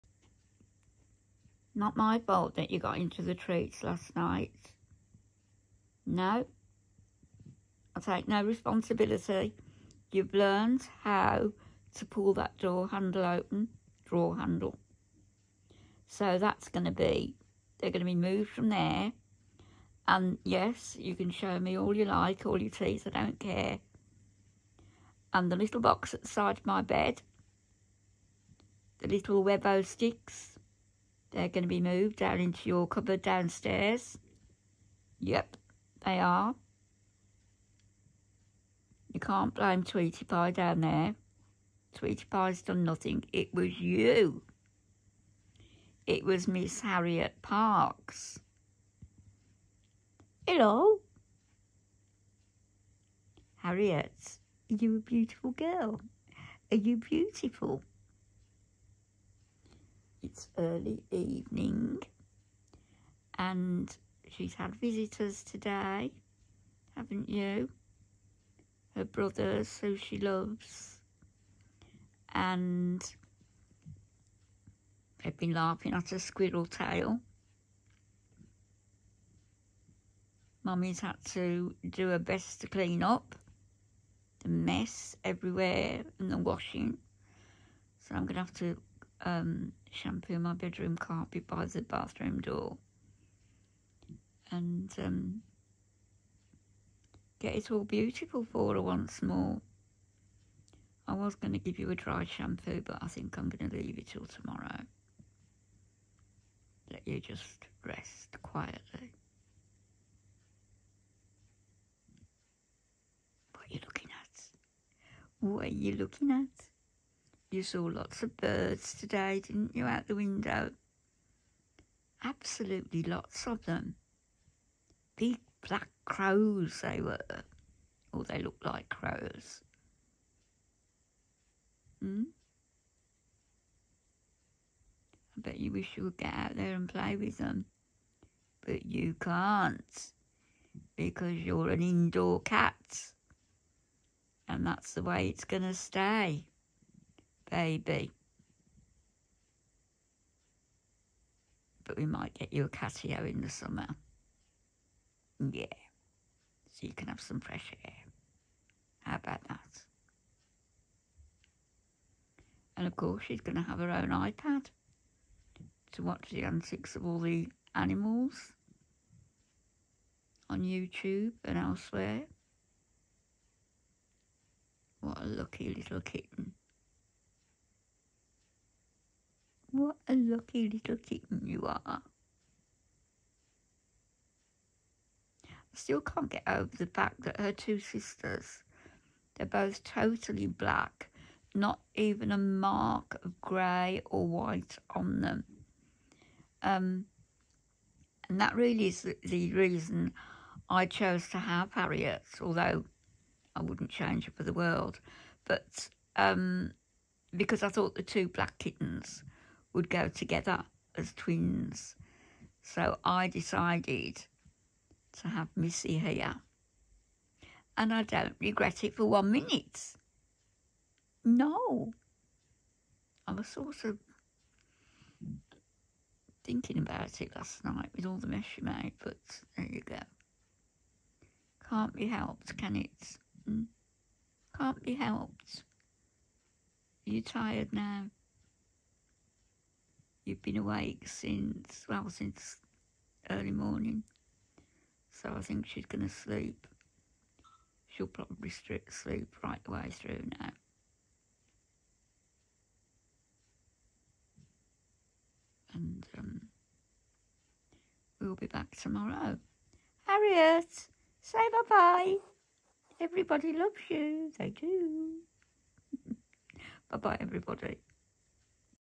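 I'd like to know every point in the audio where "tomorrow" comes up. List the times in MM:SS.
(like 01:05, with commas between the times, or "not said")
01:44, 04:18.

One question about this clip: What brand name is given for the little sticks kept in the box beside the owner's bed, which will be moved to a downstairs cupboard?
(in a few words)
Webbox.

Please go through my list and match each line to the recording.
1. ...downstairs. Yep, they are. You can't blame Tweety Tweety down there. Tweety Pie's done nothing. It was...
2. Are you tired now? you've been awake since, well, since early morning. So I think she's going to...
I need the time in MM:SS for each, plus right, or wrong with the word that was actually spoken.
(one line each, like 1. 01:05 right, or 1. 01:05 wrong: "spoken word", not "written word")
1. 00:33 wrong: "Pie", not "Tweety"
2. 03:57 right.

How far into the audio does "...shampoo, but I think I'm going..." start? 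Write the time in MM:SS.
01:42.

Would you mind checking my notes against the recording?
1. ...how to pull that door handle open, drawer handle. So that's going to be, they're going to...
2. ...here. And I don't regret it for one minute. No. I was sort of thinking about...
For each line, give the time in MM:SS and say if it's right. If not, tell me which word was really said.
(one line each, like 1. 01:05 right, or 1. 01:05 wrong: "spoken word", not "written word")
1. 00:11 right
2. 03:35 right.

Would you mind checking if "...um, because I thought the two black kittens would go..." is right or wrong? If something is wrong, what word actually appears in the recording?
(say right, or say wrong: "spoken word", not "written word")
right.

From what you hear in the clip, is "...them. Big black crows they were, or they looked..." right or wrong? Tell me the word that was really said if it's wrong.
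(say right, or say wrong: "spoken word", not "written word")
right.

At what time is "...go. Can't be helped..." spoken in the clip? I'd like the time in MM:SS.
03:49.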